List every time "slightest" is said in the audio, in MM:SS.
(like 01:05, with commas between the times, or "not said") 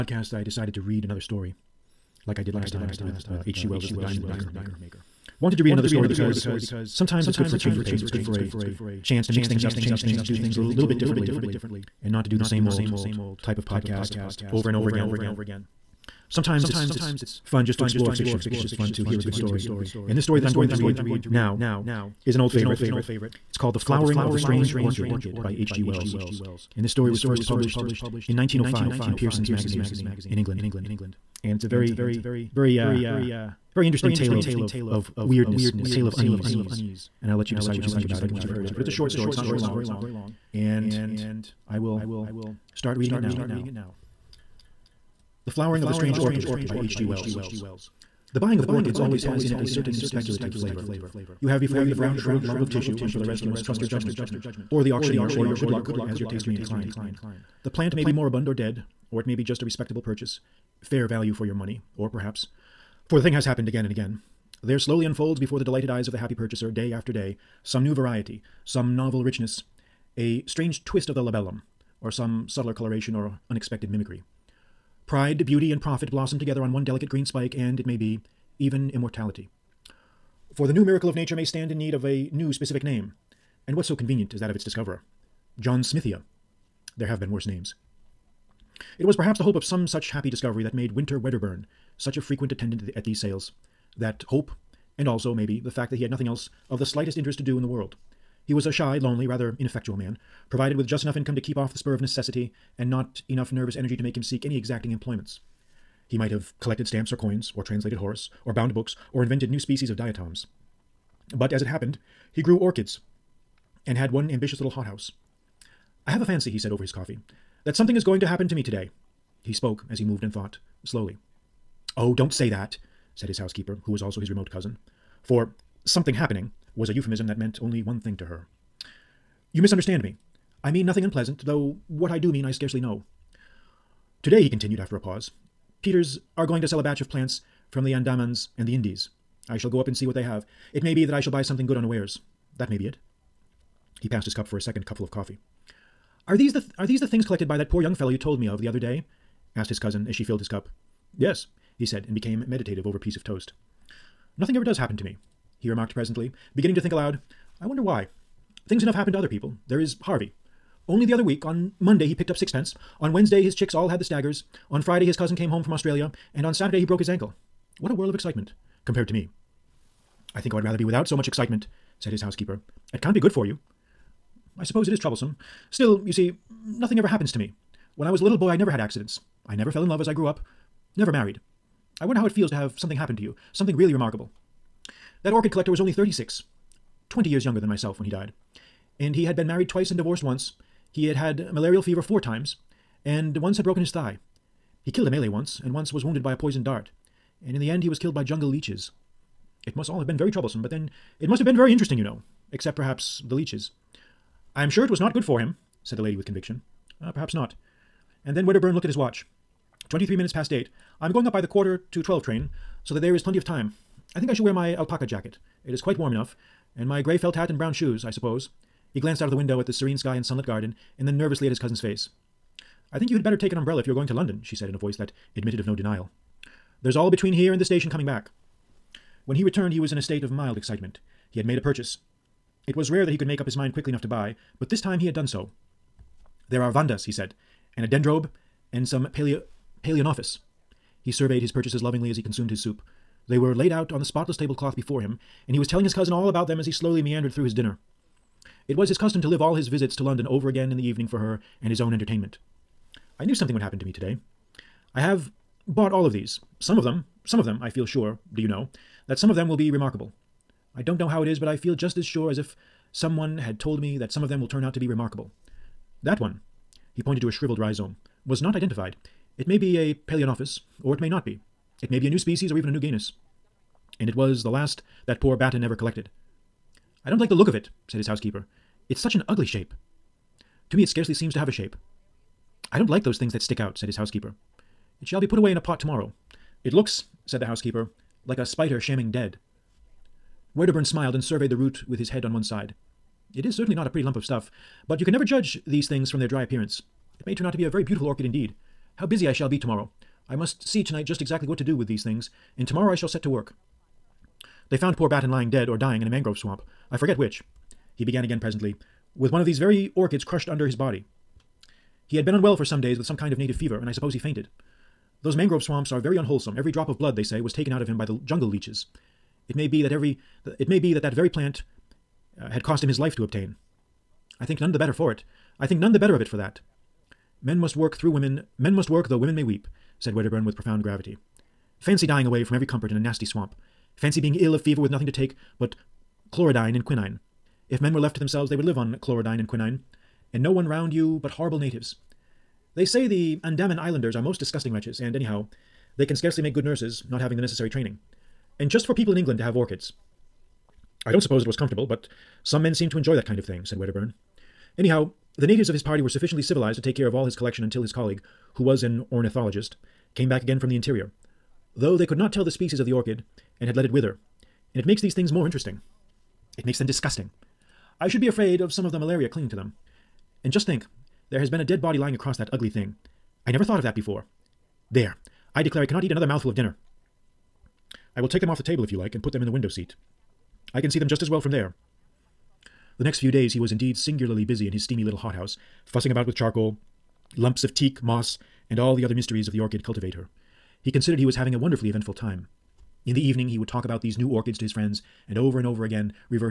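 01:36.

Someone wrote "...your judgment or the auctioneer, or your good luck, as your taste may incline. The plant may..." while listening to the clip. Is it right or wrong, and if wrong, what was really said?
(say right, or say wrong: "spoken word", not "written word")
right.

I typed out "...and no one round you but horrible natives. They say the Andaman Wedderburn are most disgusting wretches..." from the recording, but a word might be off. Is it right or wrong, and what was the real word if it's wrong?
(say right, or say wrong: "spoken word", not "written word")
wrong: "Islanders", not "Wedderburn".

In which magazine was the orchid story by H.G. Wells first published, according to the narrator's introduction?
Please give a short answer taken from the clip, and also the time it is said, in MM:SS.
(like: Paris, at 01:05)
Pearson's Magazine, at 00:29.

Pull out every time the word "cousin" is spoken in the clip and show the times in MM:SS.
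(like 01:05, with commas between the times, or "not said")
02:04, 02:29, 02:45, 03:41, 04:05.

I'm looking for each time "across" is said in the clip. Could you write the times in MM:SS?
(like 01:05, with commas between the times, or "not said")
06:12.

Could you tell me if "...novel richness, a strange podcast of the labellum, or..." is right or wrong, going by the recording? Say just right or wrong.
wrong.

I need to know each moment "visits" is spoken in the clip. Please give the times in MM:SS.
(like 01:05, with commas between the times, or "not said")
04:09.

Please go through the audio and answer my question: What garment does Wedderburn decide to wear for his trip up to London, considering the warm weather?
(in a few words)
Alpaca jacket.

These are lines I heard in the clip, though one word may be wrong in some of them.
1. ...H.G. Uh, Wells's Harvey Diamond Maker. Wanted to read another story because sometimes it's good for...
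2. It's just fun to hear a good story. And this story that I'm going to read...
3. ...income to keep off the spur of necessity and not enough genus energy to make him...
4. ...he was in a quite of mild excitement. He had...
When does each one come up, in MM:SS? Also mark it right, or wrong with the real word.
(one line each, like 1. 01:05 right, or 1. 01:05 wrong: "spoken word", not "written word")
1. 00:03 wrong: "The", not "Harvey"
2. 00:18 right
3. 01:41 wrong: "nervous", not "genus"
4. 03:49 wrong: "state", not "quite".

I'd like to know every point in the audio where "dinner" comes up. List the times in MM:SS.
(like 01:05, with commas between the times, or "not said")
04:07, 06:16.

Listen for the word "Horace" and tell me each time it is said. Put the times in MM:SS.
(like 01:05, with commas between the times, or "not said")
01:47.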